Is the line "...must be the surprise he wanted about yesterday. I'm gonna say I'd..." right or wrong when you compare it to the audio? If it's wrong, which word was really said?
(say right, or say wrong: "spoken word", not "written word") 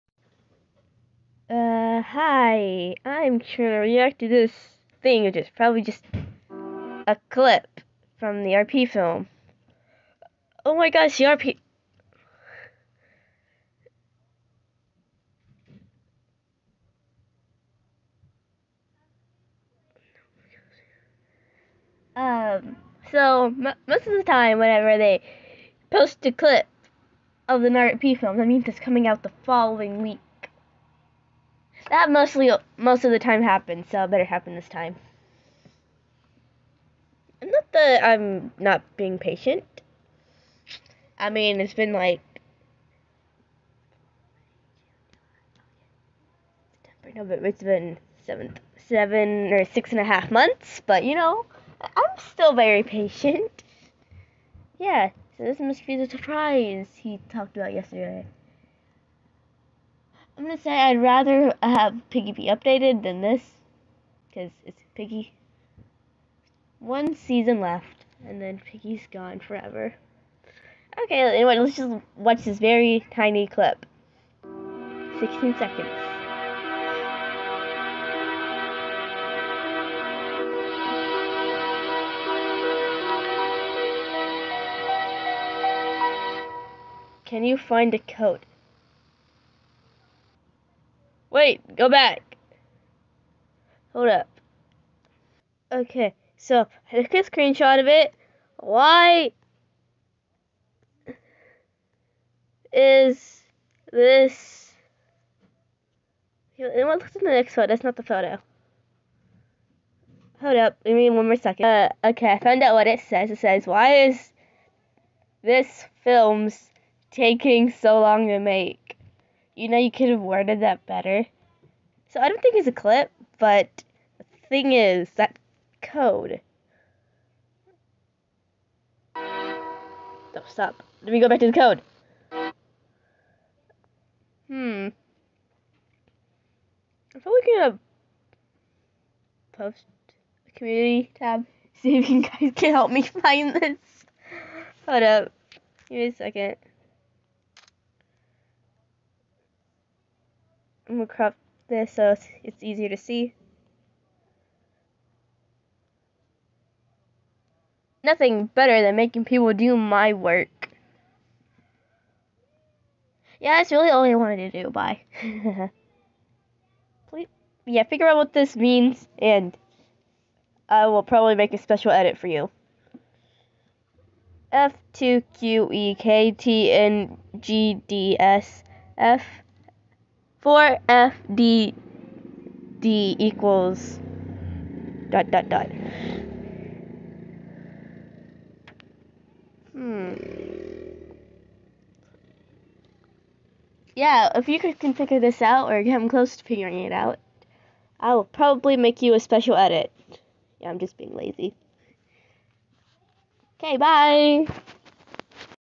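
wrong: "talked", not "wanted".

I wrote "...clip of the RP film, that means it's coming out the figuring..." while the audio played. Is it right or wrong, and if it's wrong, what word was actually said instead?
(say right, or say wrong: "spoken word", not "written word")
wrong: "following", not "figuring".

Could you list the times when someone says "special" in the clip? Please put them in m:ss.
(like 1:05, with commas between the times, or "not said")
2:51, 3:19.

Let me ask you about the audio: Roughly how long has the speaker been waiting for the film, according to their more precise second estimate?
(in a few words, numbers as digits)
6 and a half months.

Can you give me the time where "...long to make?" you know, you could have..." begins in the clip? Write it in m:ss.
1:58.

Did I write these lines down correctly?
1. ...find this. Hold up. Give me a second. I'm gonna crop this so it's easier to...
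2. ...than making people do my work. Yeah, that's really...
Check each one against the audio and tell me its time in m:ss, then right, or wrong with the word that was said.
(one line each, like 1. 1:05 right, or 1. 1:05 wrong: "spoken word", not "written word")
1. 2:23 right
2. 2:38 right.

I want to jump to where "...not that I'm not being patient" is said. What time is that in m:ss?
0:37.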